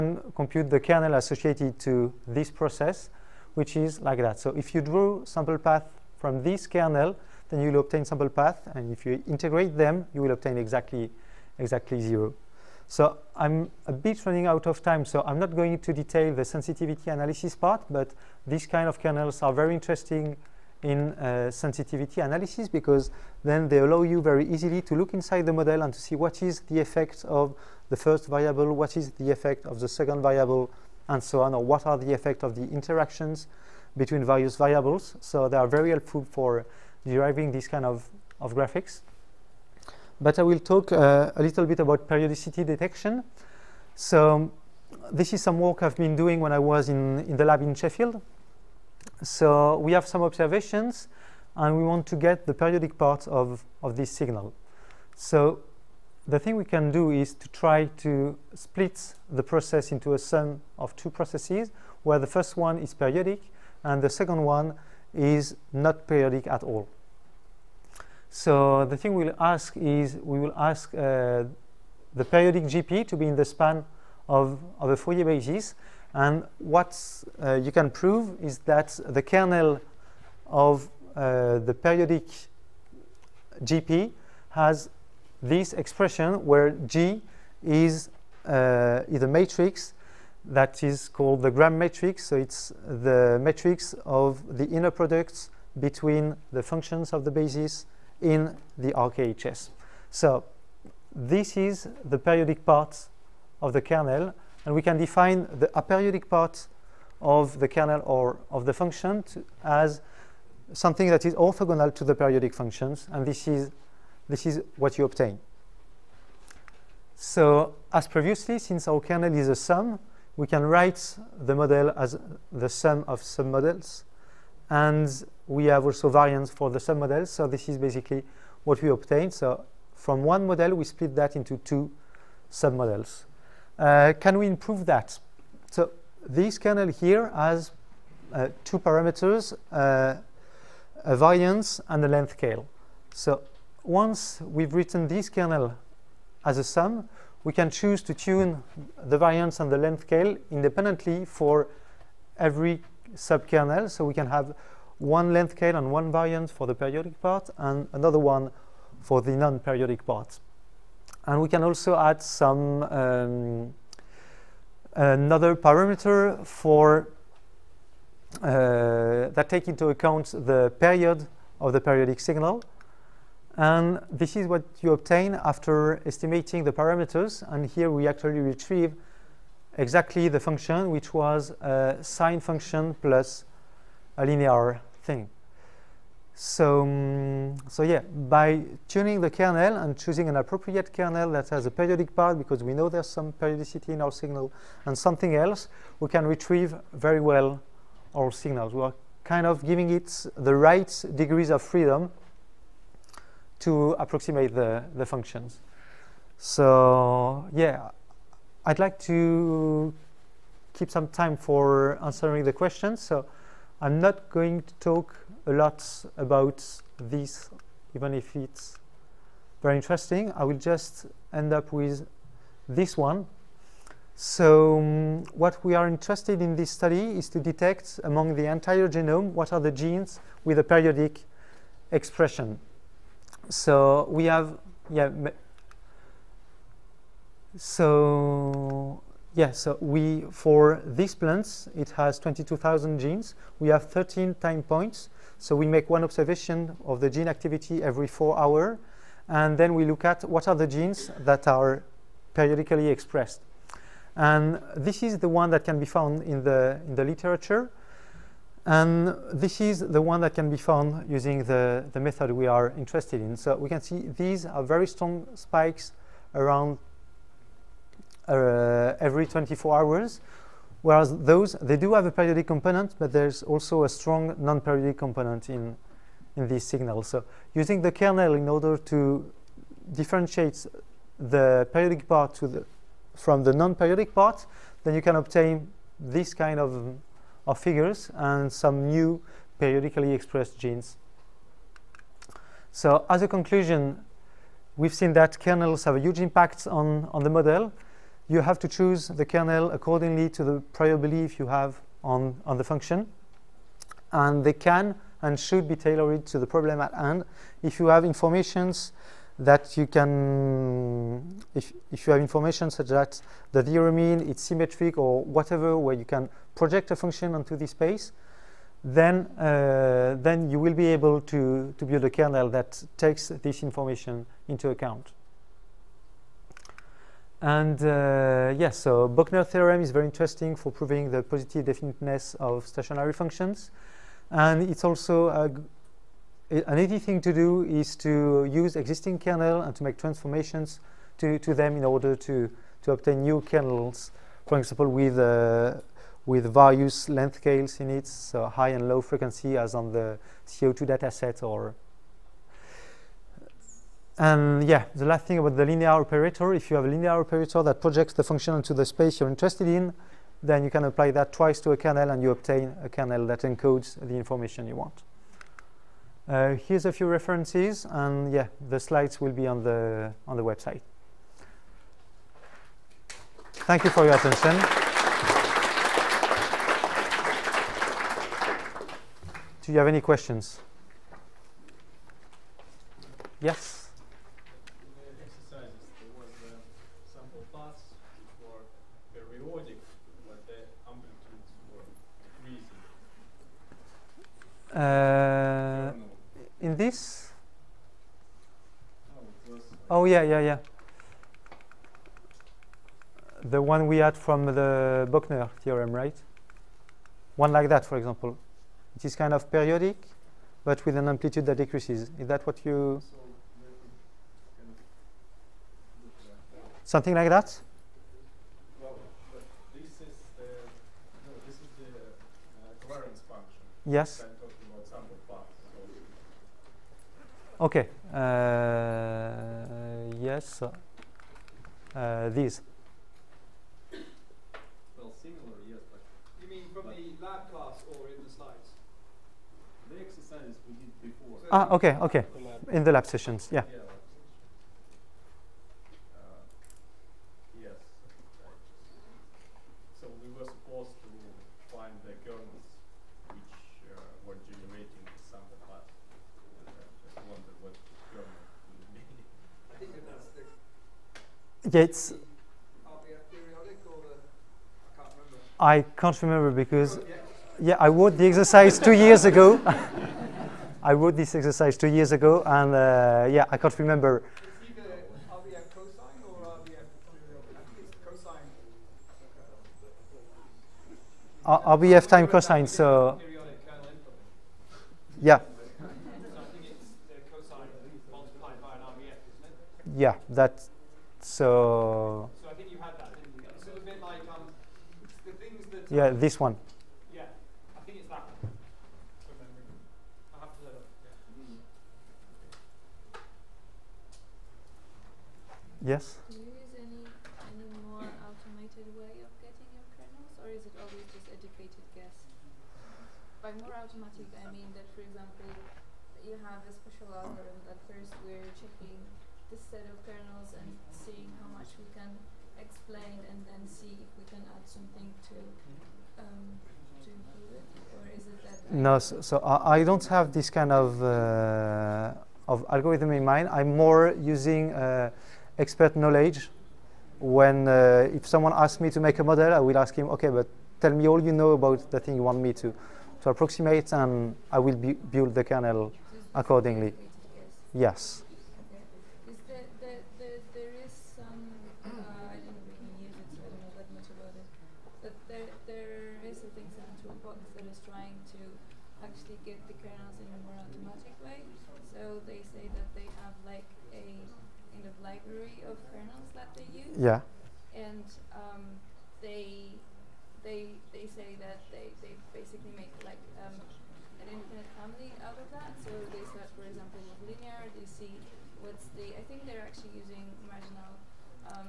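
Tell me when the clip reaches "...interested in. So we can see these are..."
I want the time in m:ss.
4:22.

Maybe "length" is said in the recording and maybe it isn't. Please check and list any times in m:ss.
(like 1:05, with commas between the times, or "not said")
2:22, 2:29, 2:35, 5:47.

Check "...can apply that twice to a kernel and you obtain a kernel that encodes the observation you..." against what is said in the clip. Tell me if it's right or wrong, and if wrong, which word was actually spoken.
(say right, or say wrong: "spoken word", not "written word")
wrong: "information", not "observation".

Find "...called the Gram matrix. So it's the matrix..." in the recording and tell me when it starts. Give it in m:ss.
1:31.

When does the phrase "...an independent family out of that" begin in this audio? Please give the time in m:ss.
9:34.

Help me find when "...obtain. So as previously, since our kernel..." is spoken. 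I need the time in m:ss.
1:55.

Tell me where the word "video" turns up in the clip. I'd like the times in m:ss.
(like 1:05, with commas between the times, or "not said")
not said.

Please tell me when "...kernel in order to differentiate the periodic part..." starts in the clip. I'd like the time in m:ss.
4:37.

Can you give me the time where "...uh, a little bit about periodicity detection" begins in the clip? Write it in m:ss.
0:40.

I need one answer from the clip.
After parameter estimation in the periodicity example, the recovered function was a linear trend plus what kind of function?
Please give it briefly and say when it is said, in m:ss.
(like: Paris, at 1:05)
sine function, at 3:02.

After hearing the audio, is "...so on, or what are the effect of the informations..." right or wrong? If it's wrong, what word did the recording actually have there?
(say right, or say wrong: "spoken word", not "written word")
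wrong: "interactions", not "informations".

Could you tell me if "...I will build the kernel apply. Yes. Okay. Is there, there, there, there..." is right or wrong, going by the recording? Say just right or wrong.
wrong.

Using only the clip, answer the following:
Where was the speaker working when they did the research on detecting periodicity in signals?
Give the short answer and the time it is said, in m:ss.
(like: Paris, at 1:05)
Sheffield, at 0:47.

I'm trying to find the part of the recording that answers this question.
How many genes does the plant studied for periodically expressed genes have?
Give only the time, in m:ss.
4:02.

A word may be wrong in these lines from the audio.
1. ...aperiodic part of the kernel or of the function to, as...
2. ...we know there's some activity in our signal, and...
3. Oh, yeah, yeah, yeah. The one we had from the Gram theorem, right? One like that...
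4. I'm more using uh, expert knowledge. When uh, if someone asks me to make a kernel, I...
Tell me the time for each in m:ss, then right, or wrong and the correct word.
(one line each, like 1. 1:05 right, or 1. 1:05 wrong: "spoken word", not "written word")
1. 1:45 right
2. 3:12 wrong: "periodicity", not "activity"
3. 6:39 wrong: "Bochner", not "Gram"
4. 8:53 wrong: "model", not "kernel".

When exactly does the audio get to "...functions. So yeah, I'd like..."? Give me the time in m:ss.
3:25.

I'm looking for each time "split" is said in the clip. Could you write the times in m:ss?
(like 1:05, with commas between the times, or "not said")
0:58, 2:10.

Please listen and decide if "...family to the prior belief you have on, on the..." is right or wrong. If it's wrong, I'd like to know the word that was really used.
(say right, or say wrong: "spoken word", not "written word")
wrong: "accordingly", not "family".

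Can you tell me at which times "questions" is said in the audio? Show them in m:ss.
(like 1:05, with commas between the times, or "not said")
3:32, 6:20.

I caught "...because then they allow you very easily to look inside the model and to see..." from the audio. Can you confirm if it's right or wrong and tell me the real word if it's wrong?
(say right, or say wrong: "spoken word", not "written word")
right.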